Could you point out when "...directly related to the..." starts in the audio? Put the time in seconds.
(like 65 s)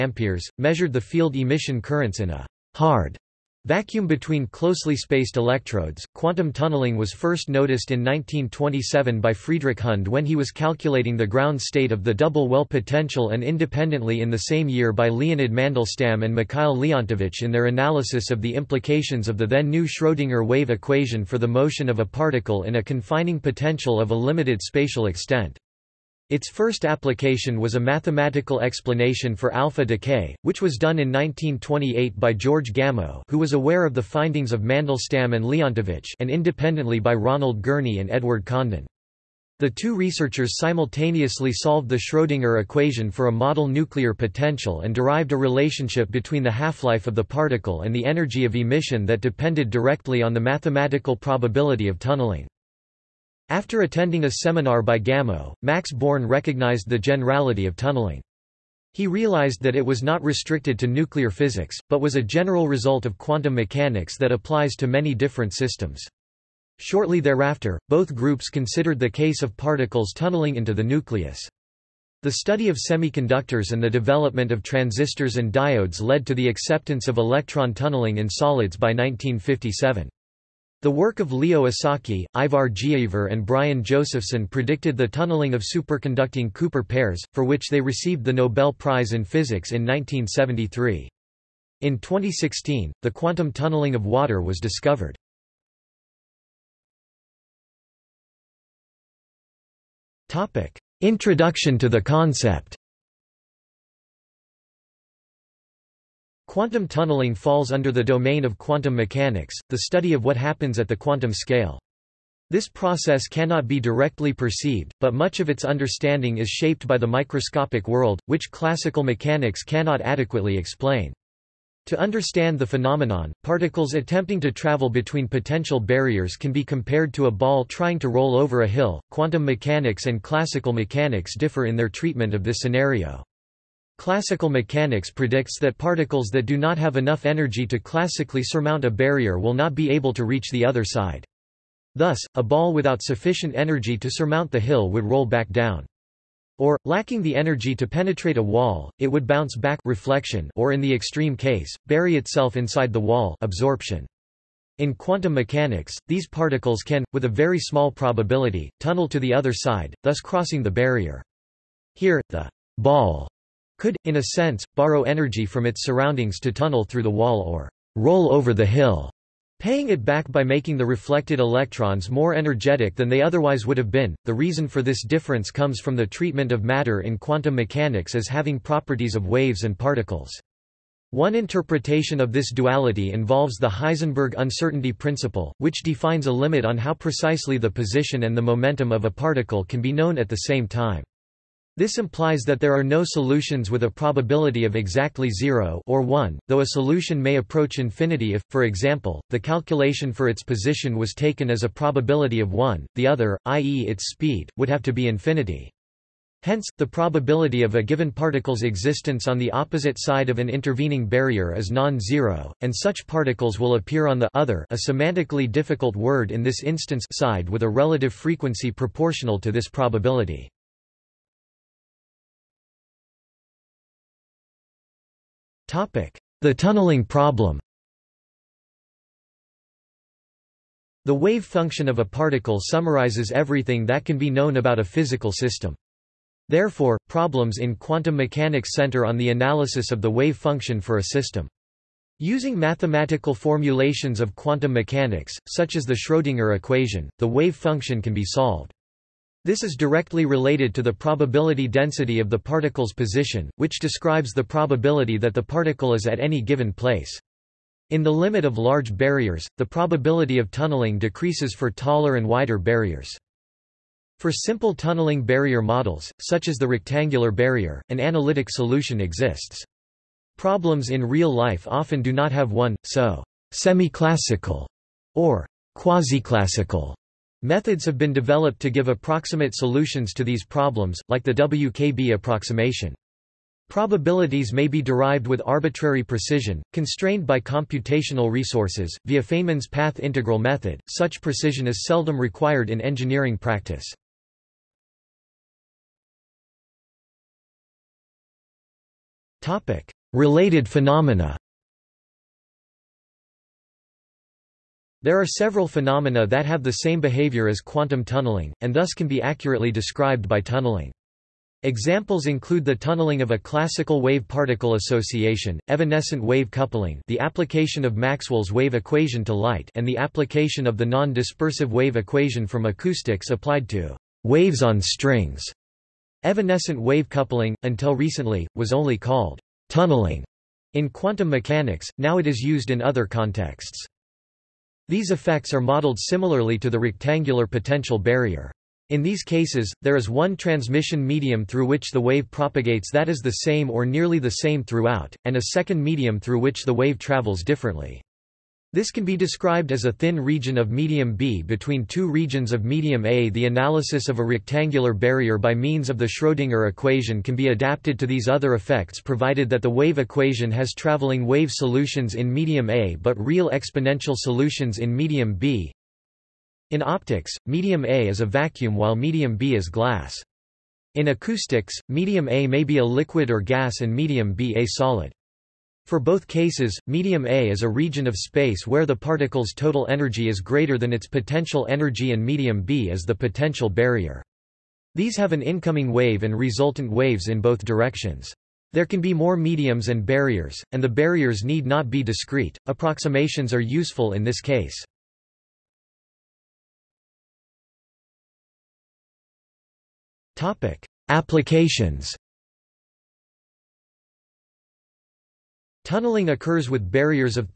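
249 s.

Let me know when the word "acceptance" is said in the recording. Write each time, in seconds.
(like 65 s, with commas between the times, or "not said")
76 s.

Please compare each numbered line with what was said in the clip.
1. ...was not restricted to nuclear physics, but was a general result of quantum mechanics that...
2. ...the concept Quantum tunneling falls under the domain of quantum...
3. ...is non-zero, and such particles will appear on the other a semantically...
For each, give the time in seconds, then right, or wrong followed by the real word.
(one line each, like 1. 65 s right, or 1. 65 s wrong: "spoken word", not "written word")
1. 59 s right
2. 101 s right
3. 211 s right.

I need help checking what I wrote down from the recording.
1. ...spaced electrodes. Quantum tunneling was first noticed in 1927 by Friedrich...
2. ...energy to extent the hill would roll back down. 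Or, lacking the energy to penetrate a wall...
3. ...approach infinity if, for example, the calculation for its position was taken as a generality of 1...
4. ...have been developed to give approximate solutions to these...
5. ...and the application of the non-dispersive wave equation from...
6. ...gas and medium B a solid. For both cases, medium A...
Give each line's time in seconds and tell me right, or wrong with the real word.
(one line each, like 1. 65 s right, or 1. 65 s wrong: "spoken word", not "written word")
1. 4 s right
2. 143 s wrong: "surmount", not "extent"
3. 197 s wrong: "probability", not "generality"
4. 277 s right
5. 319 s right
6. 373 s right.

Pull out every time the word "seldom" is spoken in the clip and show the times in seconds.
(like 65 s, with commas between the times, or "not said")
291 s.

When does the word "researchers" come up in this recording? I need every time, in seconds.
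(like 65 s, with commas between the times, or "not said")
39 s.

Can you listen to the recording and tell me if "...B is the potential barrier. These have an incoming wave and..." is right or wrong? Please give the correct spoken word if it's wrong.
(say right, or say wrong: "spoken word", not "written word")
right.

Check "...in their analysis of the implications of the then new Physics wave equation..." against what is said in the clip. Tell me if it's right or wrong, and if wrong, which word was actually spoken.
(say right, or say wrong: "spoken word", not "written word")
wrong: "Schrödinger", not "Physics".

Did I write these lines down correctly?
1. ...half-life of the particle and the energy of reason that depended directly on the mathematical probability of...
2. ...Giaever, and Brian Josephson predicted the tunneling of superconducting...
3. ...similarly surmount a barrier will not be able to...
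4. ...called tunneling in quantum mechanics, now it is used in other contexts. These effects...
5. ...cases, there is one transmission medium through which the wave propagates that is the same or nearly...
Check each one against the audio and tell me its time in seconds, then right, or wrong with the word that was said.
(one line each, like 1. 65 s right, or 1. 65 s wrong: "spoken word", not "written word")
1. 46 s wrong: "emission", not "reason"
2. 82 s right
3. 137 s wrong: "classically", not "similarly"
4. 328 s right
5. 339 s right.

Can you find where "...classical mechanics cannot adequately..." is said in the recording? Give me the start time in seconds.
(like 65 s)
118 s.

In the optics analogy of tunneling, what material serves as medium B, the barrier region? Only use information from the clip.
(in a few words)
Glass.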